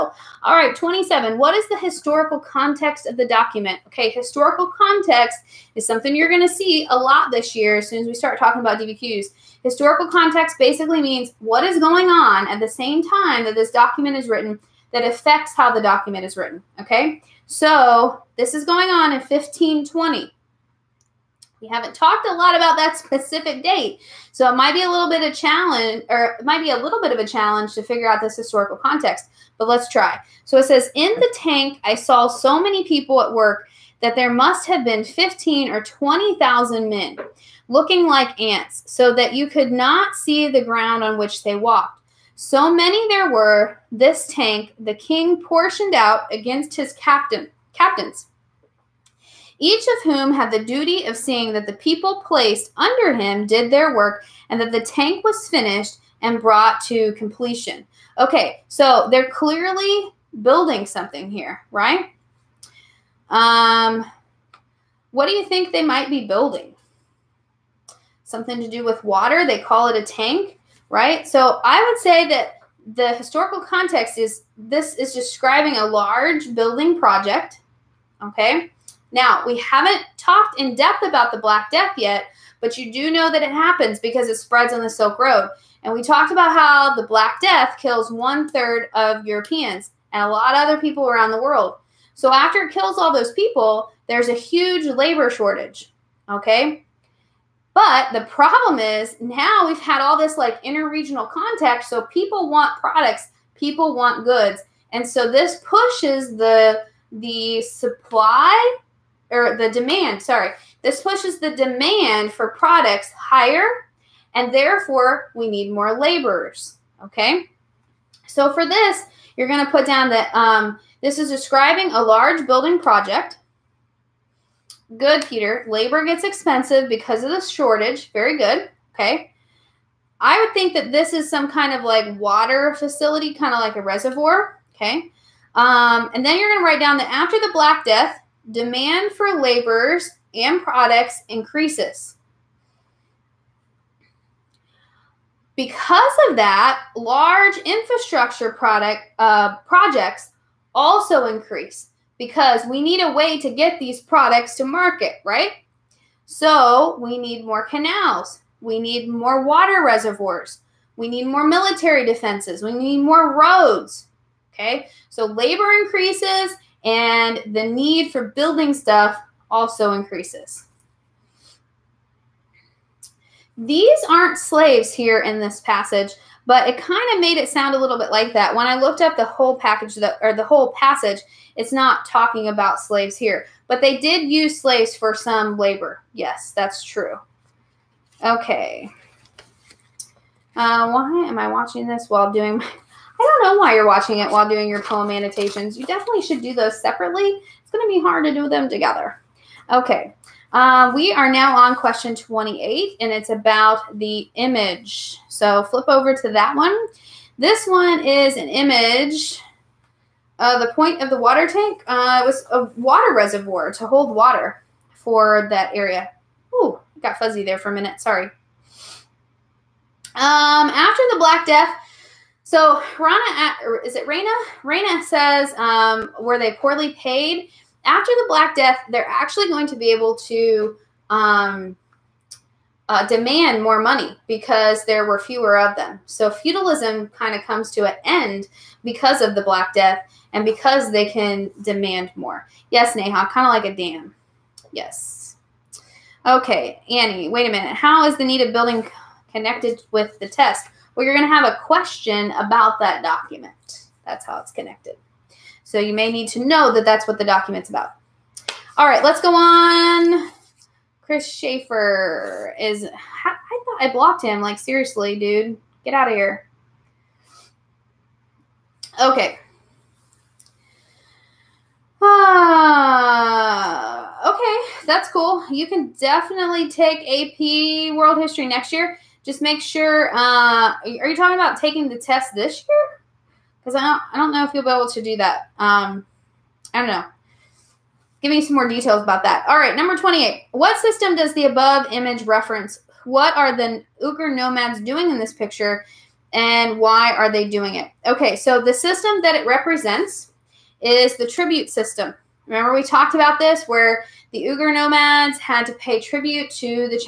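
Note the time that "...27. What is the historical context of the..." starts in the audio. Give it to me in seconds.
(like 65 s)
0 s.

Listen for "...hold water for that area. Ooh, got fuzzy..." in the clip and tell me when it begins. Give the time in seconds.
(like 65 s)
213 s.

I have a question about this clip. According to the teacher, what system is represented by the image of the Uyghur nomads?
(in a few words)
the tribute system.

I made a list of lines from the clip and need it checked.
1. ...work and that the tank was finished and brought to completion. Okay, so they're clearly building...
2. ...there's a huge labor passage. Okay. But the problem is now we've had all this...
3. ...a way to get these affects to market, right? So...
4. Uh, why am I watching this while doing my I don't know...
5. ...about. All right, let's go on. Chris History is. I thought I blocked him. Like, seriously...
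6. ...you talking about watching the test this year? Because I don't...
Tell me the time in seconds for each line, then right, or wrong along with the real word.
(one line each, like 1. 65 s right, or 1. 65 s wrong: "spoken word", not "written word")
1. 53 s right
2. 94 s wrong: "shortage", not "passage"
3. 153 s wrong: "products", not "affects"
4. 190 s right
5. 257 s wrong: "Schaefer", not "History"
6. 281 s wrong: "taking", not "watching".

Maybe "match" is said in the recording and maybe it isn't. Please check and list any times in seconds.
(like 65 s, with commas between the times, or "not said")
not said.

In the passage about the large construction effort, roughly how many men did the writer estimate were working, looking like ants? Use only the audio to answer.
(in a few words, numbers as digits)
15 or 20,000.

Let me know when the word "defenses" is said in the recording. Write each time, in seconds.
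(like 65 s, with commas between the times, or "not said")
162 s.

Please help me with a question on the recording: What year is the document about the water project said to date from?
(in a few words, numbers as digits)
1520.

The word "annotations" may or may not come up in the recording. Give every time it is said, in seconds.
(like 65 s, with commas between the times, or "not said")
195 s.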